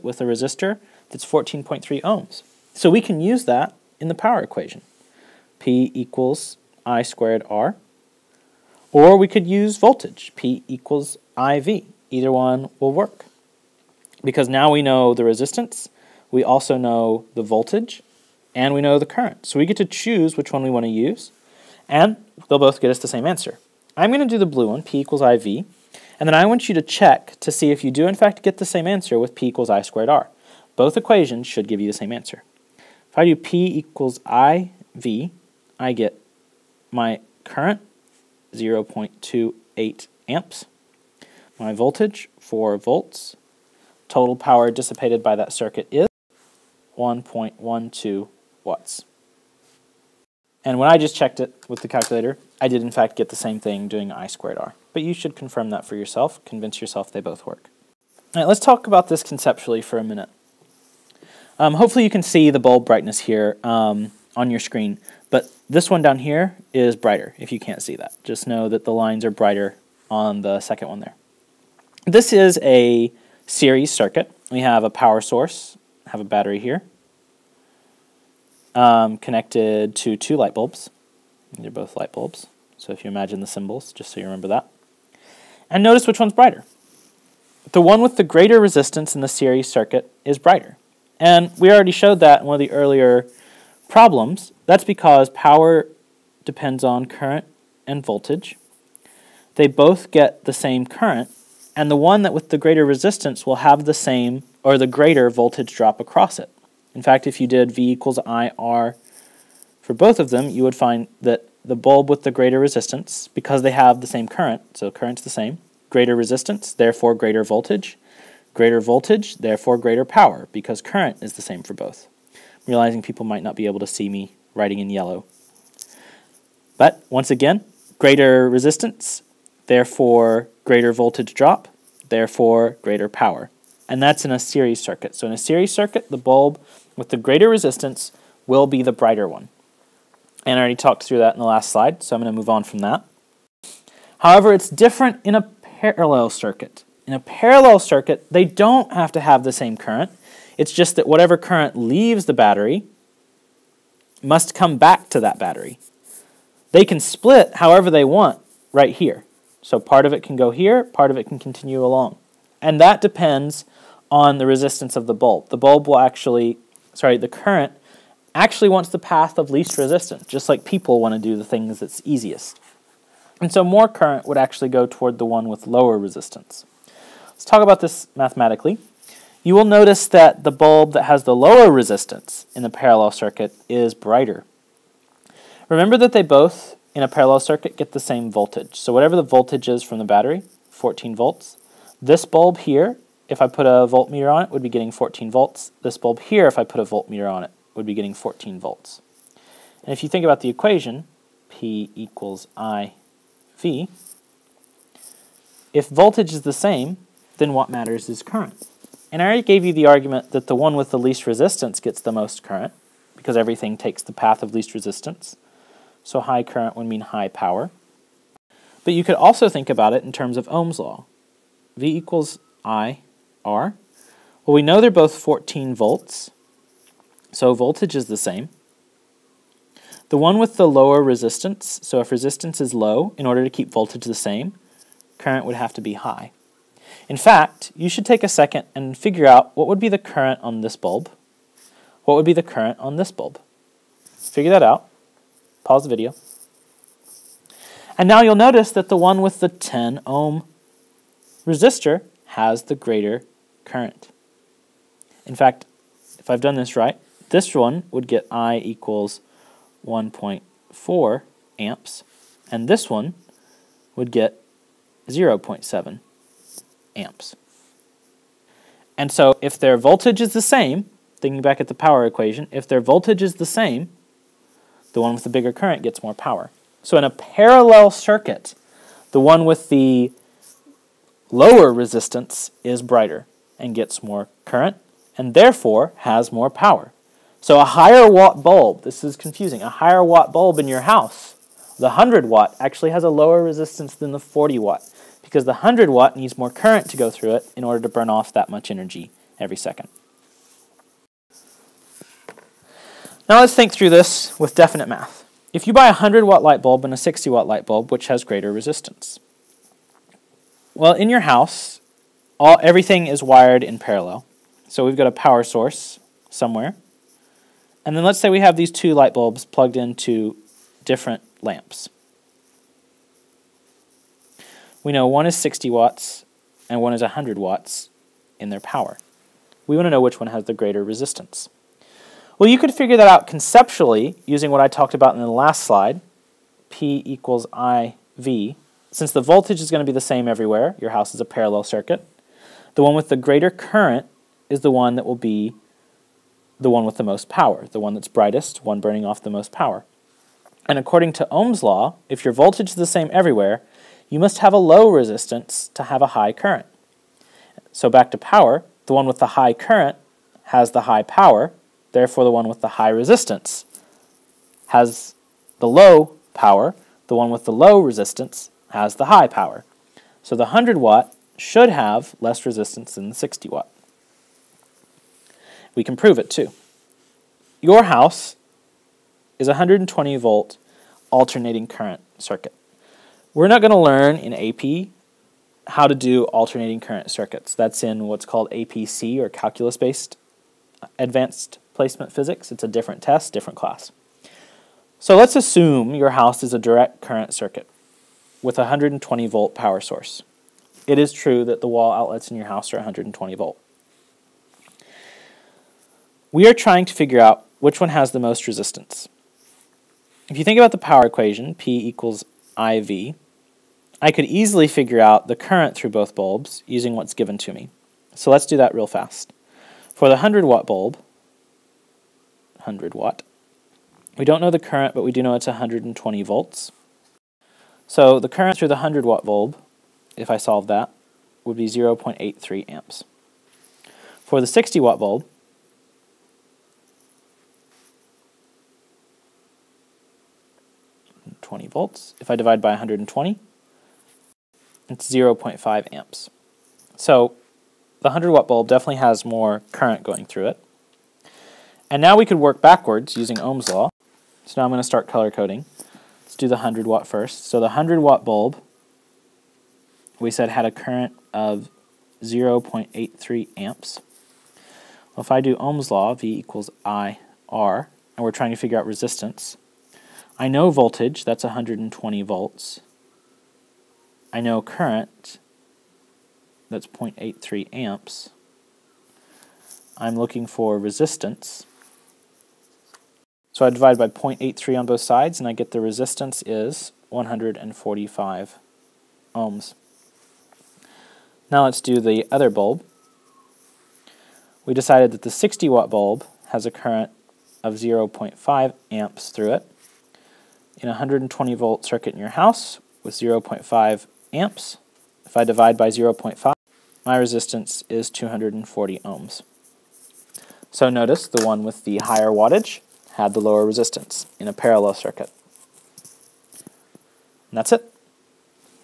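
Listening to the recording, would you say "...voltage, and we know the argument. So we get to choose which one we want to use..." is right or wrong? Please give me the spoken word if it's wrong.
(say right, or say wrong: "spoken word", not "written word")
wrong: "current", not "argument".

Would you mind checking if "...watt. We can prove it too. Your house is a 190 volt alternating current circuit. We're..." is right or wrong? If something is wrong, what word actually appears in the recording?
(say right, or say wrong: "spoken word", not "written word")
wrong: "120", not "190".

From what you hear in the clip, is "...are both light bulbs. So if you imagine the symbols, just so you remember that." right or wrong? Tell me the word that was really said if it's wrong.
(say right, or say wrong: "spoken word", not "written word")
right.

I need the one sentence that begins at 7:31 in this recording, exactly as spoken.
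And now we could work backwards using Ohm's law.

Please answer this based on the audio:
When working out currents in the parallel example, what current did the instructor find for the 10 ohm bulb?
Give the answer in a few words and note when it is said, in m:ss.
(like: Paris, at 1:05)
1.4 amps, at 4:19.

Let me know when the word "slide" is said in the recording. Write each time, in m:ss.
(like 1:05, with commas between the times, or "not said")
2:21, 5:35.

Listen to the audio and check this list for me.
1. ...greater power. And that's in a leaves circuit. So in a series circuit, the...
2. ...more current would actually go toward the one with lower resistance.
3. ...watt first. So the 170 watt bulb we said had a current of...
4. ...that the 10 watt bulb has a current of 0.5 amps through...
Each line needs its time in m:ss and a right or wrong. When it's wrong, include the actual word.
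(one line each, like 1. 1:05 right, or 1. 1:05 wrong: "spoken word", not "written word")
1. 2:12 wrong: "series", not "leaves"
2. 2:53 right
3. 7:36 wrong: "100", not "170"
4. 8:15 wrong: "60", not "10".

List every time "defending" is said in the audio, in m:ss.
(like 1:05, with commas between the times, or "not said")
not said.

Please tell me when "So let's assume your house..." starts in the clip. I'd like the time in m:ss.
6:34.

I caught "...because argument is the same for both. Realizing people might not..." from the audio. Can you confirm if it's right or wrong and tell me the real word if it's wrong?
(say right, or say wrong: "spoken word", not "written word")
wrong: "current", not "argument".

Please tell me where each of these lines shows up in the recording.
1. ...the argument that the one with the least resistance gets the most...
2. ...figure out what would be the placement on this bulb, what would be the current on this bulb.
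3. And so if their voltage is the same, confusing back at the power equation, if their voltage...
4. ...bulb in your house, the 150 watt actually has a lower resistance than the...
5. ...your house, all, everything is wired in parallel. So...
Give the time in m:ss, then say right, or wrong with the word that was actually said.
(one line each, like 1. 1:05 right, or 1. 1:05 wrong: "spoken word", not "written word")
1. 3:29 right
2. 3:58 wrong: "current", not "placement"
3. 4:28 wrong: "thinking", not "confusing"
4. 4:50 wrong: "100", not "150"
5. 5:11 right.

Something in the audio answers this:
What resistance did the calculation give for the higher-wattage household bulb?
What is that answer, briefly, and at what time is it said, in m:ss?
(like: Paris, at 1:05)
145 ohms, at 8:07.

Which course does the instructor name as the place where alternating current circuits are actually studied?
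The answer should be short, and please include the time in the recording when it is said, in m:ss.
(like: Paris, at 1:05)
APC, at 6:28.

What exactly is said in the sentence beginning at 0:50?
And when I just checked it with the calculator, I did in fact get the same thing doing I squared R.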